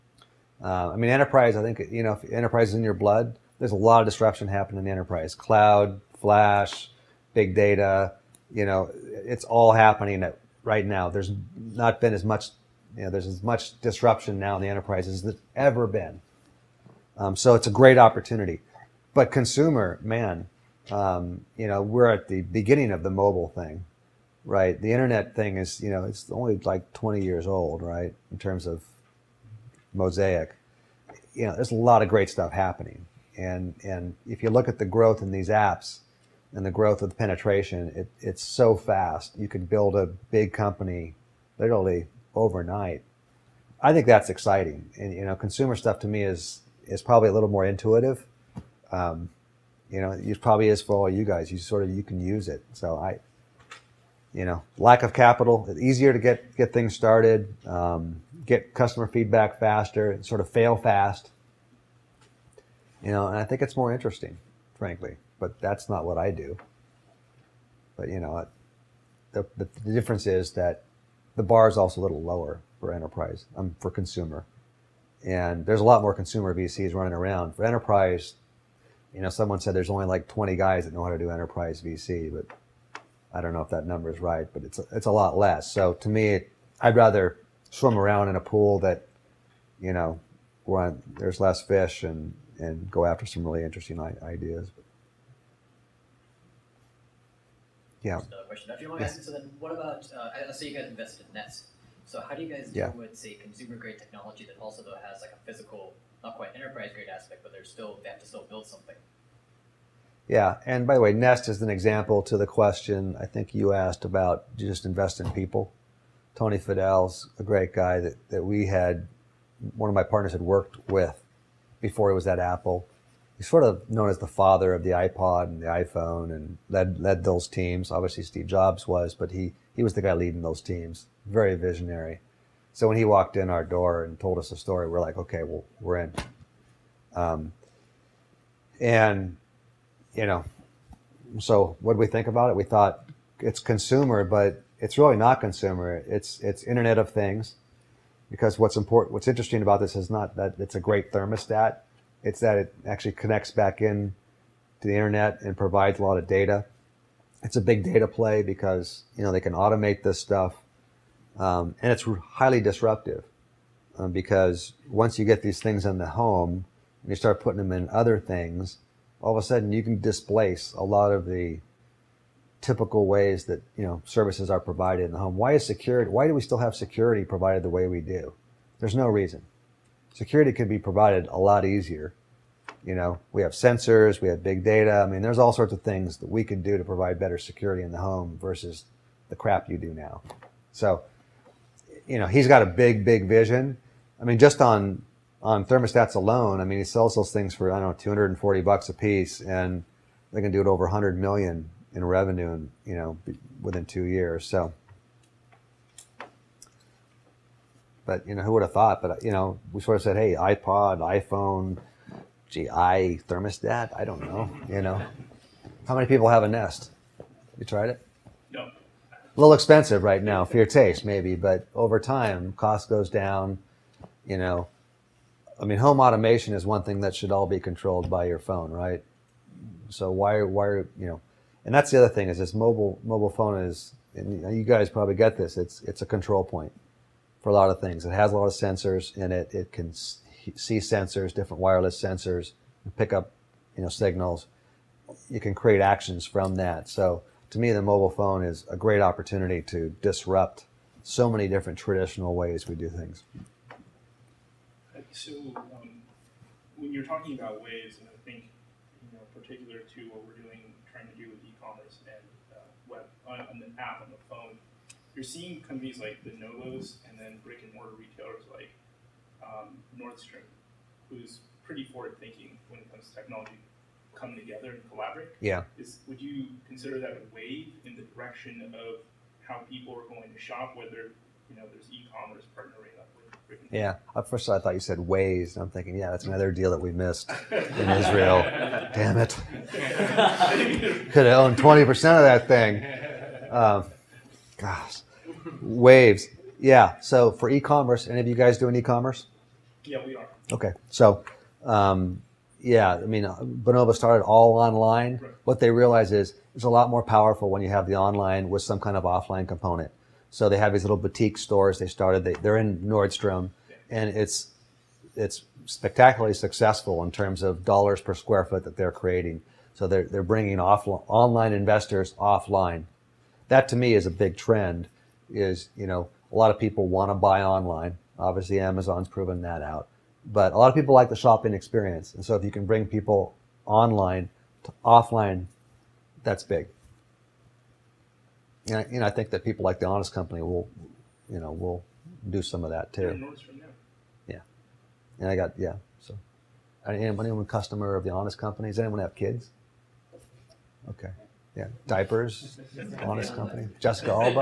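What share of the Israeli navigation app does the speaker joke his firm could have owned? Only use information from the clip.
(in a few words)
20 percent.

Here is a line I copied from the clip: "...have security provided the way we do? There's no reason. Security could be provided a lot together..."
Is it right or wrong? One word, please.
wrong.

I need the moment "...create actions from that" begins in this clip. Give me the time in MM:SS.
04:05.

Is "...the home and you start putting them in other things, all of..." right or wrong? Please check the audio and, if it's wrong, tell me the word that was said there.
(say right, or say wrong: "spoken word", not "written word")
right.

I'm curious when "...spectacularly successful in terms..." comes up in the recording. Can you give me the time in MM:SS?
05:15.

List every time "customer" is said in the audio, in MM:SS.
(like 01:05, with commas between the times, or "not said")
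00:58, 05:47.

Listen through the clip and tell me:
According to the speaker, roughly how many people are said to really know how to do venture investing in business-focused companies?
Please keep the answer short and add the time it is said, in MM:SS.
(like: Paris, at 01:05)
20, at 01:19.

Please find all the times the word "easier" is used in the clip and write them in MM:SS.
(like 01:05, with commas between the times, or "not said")
00:55, 03:01.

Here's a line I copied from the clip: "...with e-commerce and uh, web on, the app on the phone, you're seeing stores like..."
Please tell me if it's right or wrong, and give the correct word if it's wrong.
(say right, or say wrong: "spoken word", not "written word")
wrong: "companies", not "stores".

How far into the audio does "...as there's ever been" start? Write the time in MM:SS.
00:15.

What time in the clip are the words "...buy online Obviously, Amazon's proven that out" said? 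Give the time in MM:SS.
05:27.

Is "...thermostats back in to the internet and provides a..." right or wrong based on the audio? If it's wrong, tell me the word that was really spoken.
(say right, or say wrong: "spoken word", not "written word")
wrong: "connects", not "thermostats".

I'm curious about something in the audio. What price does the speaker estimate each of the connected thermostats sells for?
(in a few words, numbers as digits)
240 bucks.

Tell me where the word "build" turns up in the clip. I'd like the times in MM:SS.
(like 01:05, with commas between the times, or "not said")
00:39, 01:48.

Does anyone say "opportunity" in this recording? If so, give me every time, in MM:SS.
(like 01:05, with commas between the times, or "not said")
00:17, 04:09.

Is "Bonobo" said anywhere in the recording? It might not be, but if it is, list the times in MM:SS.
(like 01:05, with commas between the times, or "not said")
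05:03.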